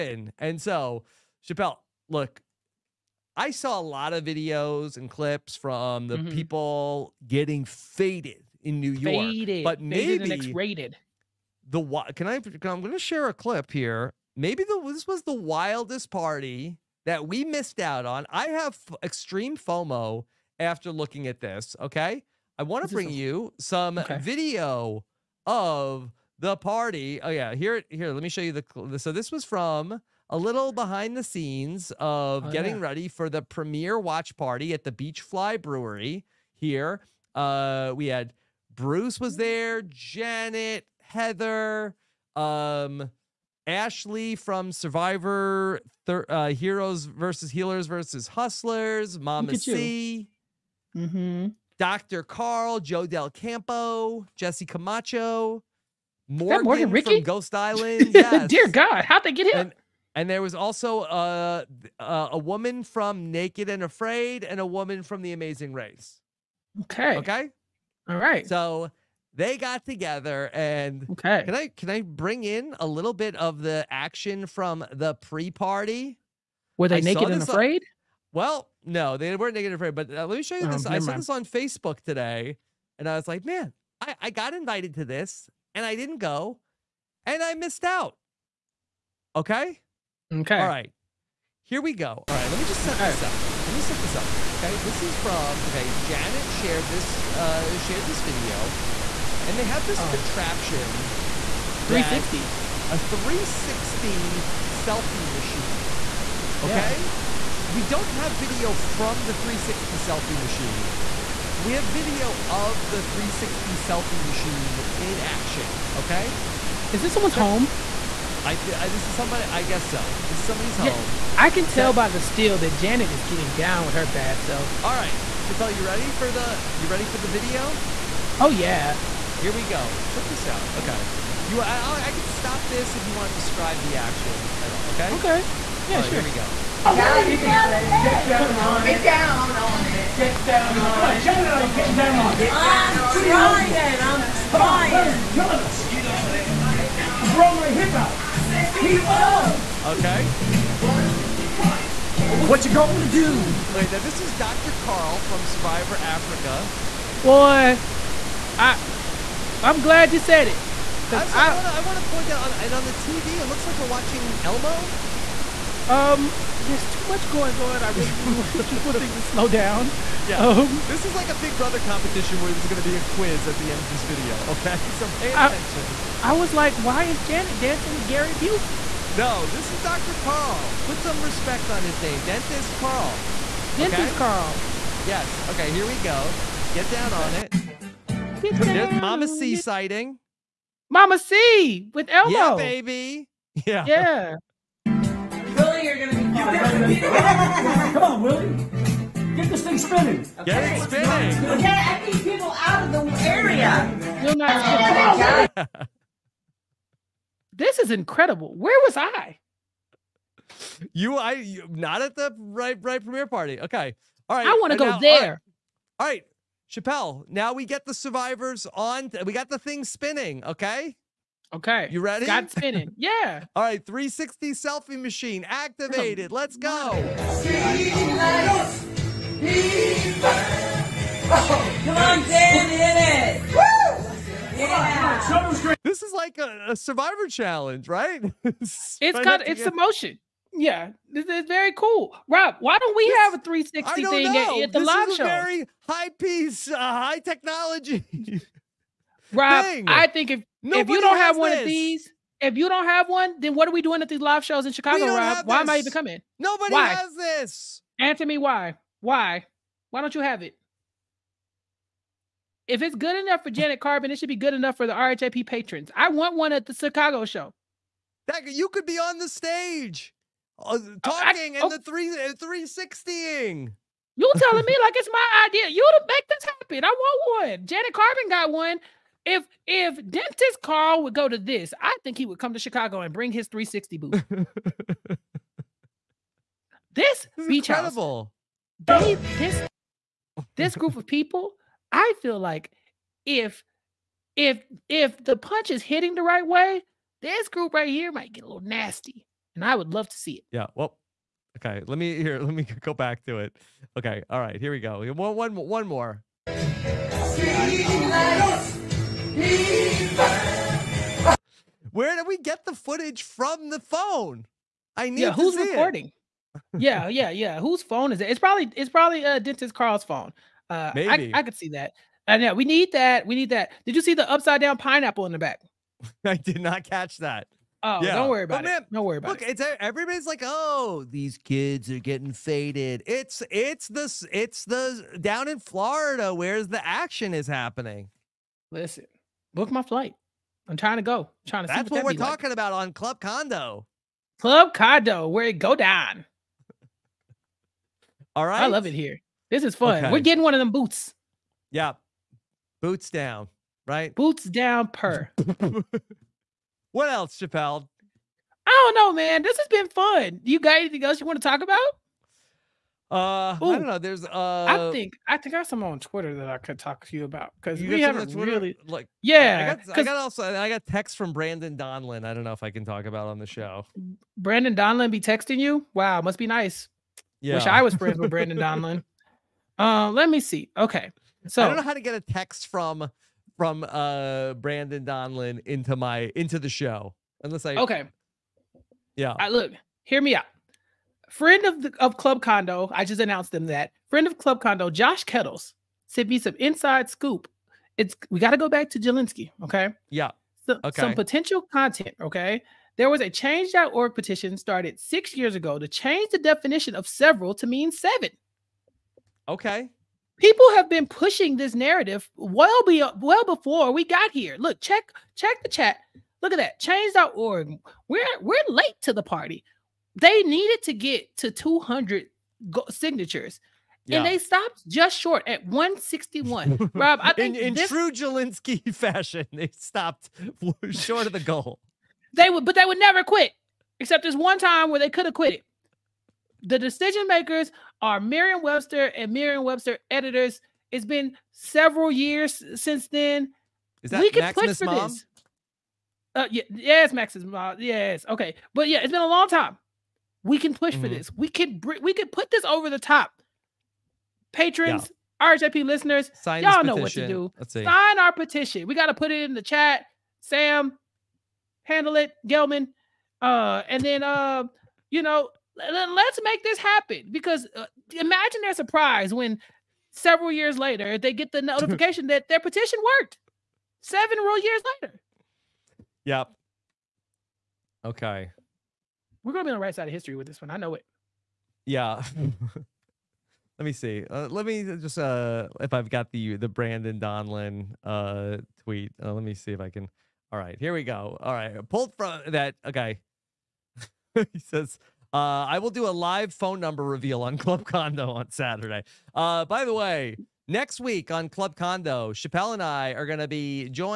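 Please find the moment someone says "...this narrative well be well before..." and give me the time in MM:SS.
06:51.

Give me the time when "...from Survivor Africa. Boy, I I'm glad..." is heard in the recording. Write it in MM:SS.
02:35.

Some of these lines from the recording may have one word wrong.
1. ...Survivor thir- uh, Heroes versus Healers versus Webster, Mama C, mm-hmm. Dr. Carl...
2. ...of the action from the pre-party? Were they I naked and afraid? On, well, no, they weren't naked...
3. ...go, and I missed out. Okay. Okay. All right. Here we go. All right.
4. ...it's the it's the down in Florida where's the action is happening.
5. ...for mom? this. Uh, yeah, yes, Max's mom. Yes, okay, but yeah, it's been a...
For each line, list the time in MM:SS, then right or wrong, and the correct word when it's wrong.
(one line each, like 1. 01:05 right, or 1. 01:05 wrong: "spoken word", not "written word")
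1. 00:44 wrong: "Hustlers", not "Webster"
2. 01:13 right
3. 01:26 right
4. 05:33 right
5. 07:24 right.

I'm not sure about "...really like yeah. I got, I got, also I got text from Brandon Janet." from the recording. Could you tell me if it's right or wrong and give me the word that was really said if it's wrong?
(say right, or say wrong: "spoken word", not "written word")
wrong: "Donlon", not "Janet".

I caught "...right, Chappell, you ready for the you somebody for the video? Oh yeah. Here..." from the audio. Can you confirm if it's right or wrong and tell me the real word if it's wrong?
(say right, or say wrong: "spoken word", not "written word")
wrong: "ready", not "somebody".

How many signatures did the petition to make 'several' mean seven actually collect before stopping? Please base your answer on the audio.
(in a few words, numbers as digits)
161.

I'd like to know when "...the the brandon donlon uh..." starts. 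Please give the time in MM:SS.
08:06.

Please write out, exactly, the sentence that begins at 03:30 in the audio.
You, I, you, not at the right, right premiere party.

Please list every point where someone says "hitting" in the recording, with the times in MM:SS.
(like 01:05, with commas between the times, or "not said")
04:55.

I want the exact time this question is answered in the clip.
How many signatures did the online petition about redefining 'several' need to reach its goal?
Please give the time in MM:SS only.
07:01.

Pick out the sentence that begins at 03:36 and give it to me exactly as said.
Chappell, now we get the survivors on.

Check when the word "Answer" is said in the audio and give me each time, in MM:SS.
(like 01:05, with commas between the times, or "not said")
04:17.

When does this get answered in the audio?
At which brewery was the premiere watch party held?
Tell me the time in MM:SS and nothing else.
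00:34.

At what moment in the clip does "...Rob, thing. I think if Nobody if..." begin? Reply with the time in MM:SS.
04:09.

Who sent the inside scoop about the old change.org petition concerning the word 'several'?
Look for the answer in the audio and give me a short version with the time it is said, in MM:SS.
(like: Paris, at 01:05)
Josh Kettles, at 06:34.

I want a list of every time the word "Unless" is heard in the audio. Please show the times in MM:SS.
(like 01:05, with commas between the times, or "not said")
06:27.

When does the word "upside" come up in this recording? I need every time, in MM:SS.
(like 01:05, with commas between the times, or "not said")
05:24.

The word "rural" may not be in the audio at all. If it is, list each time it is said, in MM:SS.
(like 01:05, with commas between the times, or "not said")
not said.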